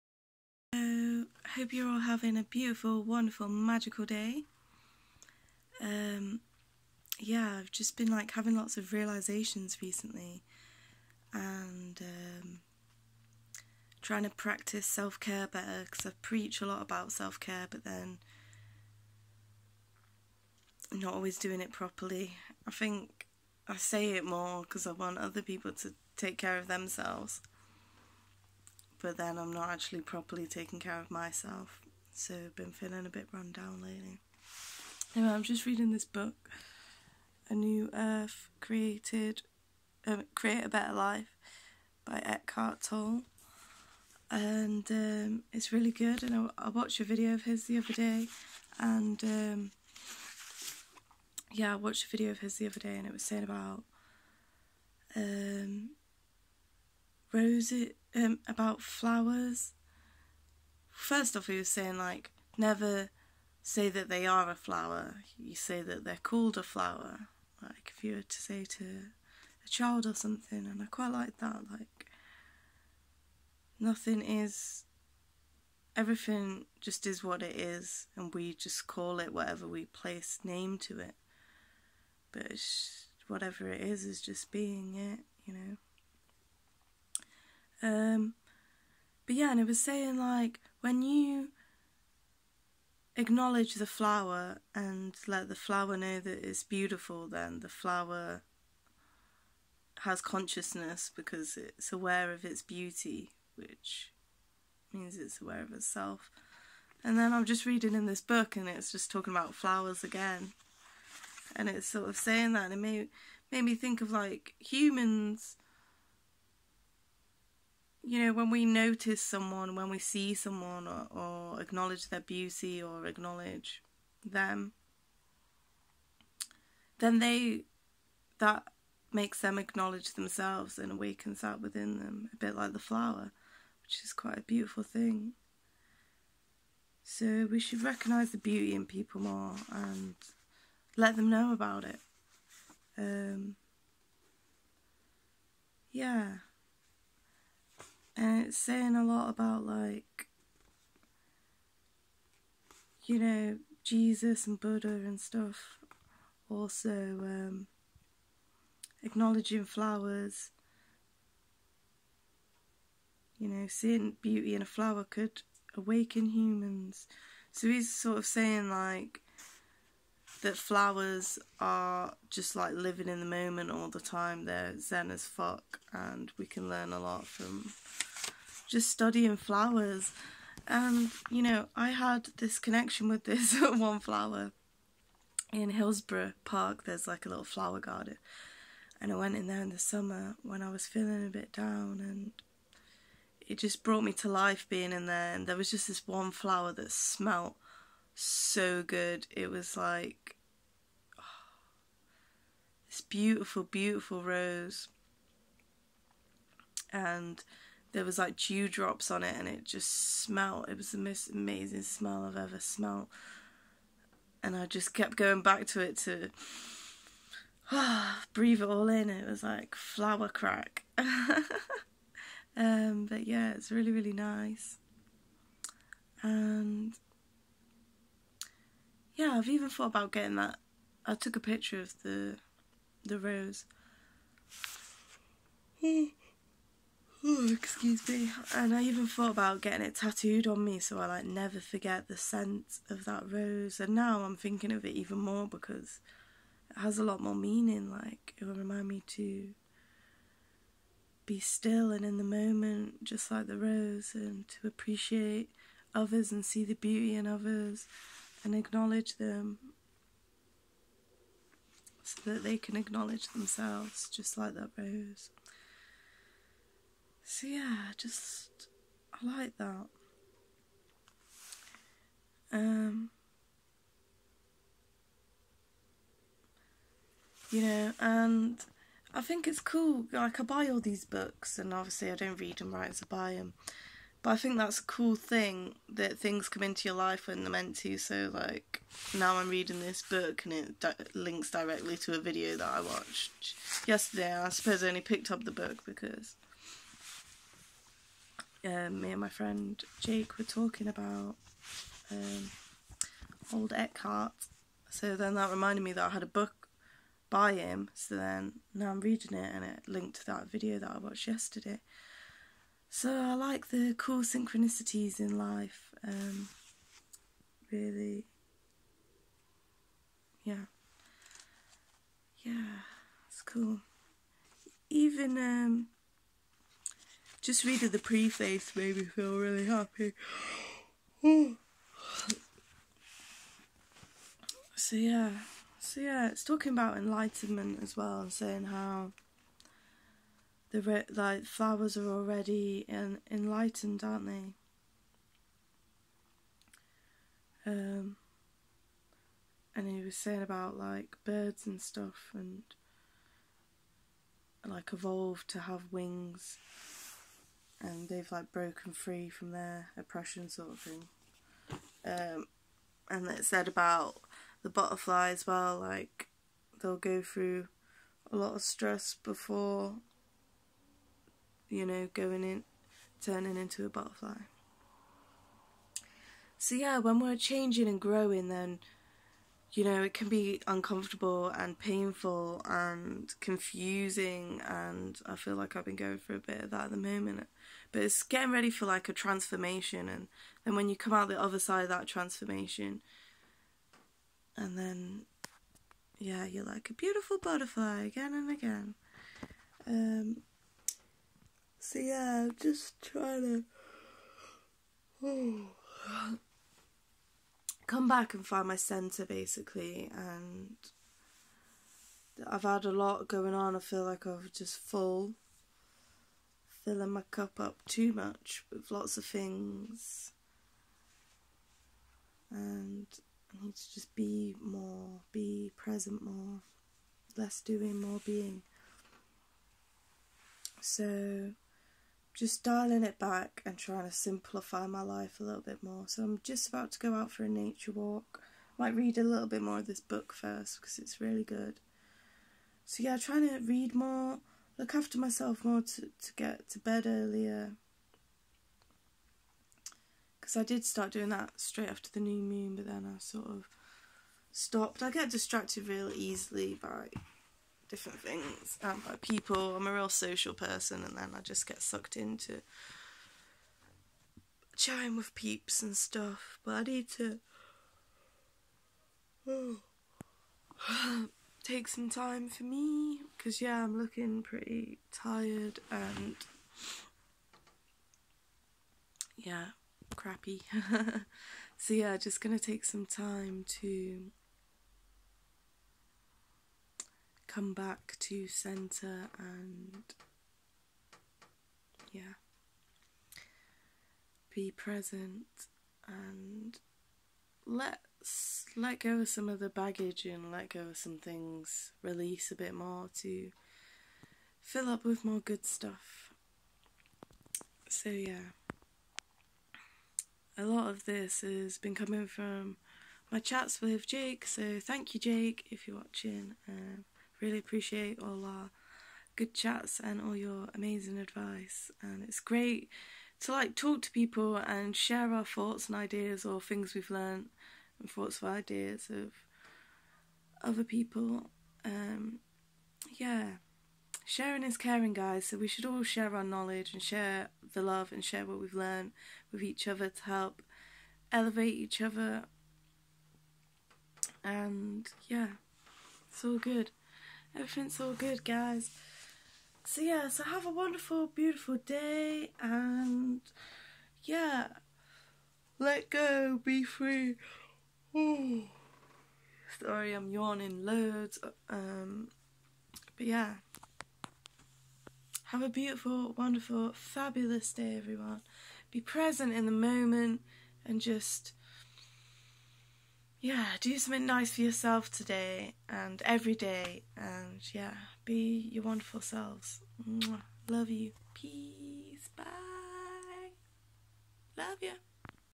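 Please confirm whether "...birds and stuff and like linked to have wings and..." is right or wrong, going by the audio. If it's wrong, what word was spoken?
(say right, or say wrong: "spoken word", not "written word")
wrong: "evolved", not "linked".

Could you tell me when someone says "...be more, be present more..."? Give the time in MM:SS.
07:04.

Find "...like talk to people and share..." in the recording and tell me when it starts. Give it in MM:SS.
08:43.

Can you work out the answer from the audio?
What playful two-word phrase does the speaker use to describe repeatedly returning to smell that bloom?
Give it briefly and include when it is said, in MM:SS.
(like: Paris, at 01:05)
Flower crack, at 03:39.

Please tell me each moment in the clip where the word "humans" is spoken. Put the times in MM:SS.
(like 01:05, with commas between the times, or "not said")
01:54, 02:46.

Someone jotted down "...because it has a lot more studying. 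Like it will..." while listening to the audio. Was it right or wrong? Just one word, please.
wrong.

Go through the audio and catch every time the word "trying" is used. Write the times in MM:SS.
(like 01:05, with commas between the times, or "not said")
00:14, 06:43, 07:13, 07:23.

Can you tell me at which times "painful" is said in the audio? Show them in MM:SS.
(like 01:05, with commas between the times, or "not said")
06:21.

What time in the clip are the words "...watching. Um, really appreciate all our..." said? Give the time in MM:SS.
08:35.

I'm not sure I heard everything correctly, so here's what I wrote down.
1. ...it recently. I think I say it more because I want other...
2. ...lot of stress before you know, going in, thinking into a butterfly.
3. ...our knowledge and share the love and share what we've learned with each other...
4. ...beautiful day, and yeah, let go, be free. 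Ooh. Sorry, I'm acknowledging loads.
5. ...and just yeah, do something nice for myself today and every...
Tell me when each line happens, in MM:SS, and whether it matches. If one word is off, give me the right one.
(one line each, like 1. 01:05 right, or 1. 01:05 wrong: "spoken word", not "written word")
1. 00:21 wrong: "properly", not "recently"
2. 06:08 wrong: "turning", not "thinking"
3. 08:56 right
4. 09:11 wrong: "yawning", not "acknowledging"
5. 09:30 wrong: "yourself", not "myself".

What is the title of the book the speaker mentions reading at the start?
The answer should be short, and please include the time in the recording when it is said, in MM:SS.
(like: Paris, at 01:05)
A New Earth, at 00:37.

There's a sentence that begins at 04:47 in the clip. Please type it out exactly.
So, like, now I'm reading this book and it di- links directly to a video that I watched yesterday.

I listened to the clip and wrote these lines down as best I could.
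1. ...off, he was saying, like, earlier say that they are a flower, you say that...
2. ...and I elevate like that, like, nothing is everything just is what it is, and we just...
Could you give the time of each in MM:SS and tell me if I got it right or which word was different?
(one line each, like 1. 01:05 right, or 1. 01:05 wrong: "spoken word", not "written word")
1. 01:01 wrong: "never", not "earlier"
2. 01:10 wrong: "quite", not "elevate".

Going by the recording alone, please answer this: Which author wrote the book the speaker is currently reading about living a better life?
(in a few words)
Eckhart Tolle.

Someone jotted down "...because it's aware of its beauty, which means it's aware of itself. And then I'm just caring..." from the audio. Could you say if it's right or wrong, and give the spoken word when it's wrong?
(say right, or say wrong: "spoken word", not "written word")
wrong: "reading", not "caring".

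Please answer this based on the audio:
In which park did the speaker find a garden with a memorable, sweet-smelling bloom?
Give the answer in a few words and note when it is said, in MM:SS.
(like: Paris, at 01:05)
Hillsborough Park, at 03:05.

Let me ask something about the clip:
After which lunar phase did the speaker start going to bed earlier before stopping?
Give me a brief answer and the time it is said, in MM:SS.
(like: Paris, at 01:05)
New moon, at 07:32.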